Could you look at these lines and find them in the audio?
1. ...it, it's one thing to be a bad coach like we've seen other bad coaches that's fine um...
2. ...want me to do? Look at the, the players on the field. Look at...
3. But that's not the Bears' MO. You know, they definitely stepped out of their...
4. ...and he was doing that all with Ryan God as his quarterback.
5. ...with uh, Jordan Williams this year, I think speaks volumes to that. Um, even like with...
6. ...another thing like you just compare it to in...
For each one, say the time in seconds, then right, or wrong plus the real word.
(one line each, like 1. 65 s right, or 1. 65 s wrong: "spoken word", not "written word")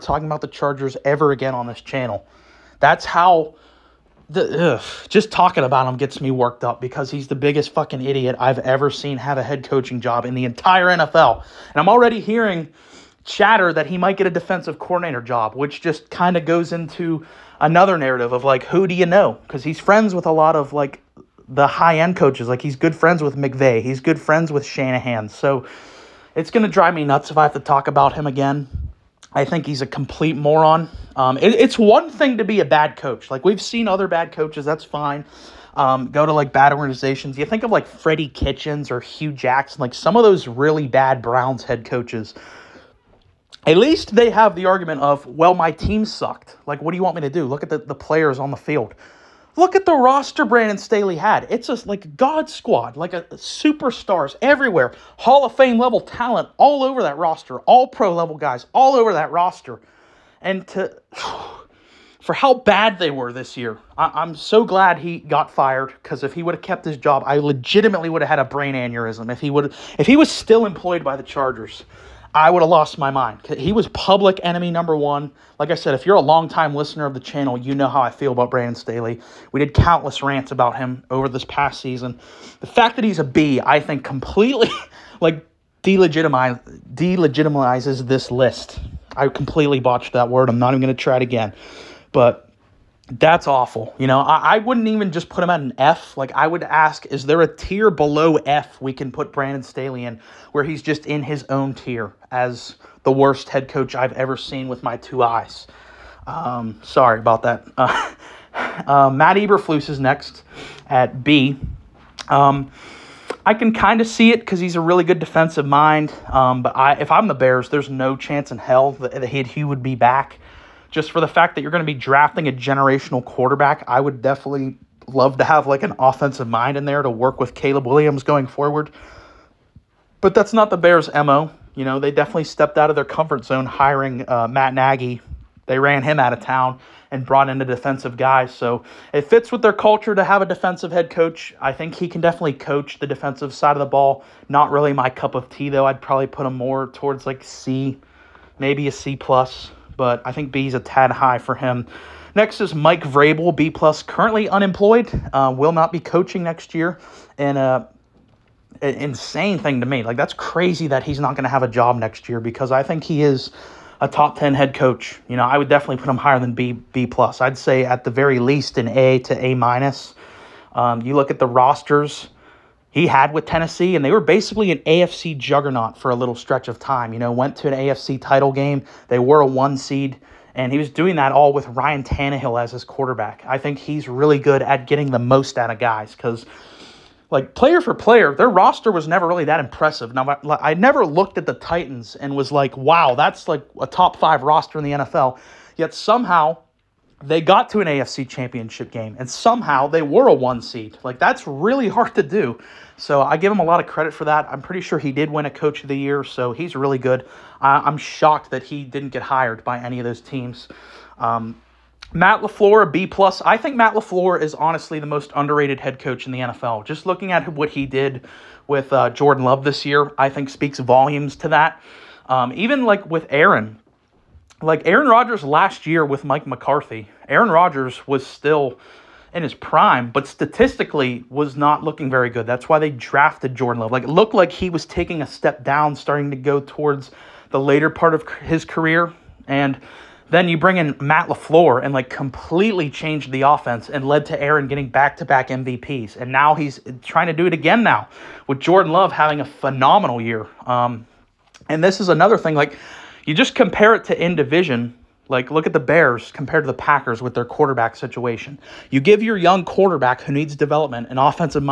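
1. 31 s right
2. 47 s right
3. 130 s right
4. 180 s wrong: "Tannehill", not "God"
5. 218 s wrong: "Love", not "Williams"
6. 252 s right.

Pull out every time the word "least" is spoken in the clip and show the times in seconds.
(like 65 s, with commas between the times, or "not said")
43 s, 168 s.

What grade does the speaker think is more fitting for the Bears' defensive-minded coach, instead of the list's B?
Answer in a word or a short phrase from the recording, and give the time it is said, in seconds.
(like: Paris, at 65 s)
C plus, at 148 s.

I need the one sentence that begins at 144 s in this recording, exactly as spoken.
Not really my cup of tea, though.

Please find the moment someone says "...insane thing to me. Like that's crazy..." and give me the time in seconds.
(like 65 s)
158 s.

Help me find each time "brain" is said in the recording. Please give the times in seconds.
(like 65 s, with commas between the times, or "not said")
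68 s.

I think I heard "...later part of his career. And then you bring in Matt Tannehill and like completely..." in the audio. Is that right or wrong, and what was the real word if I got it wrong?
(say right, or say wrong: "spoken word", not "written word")
wrong: "LaFleur", not "Tannehill".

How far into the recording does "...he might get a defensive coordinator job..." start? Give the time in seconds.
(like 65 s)
13 s.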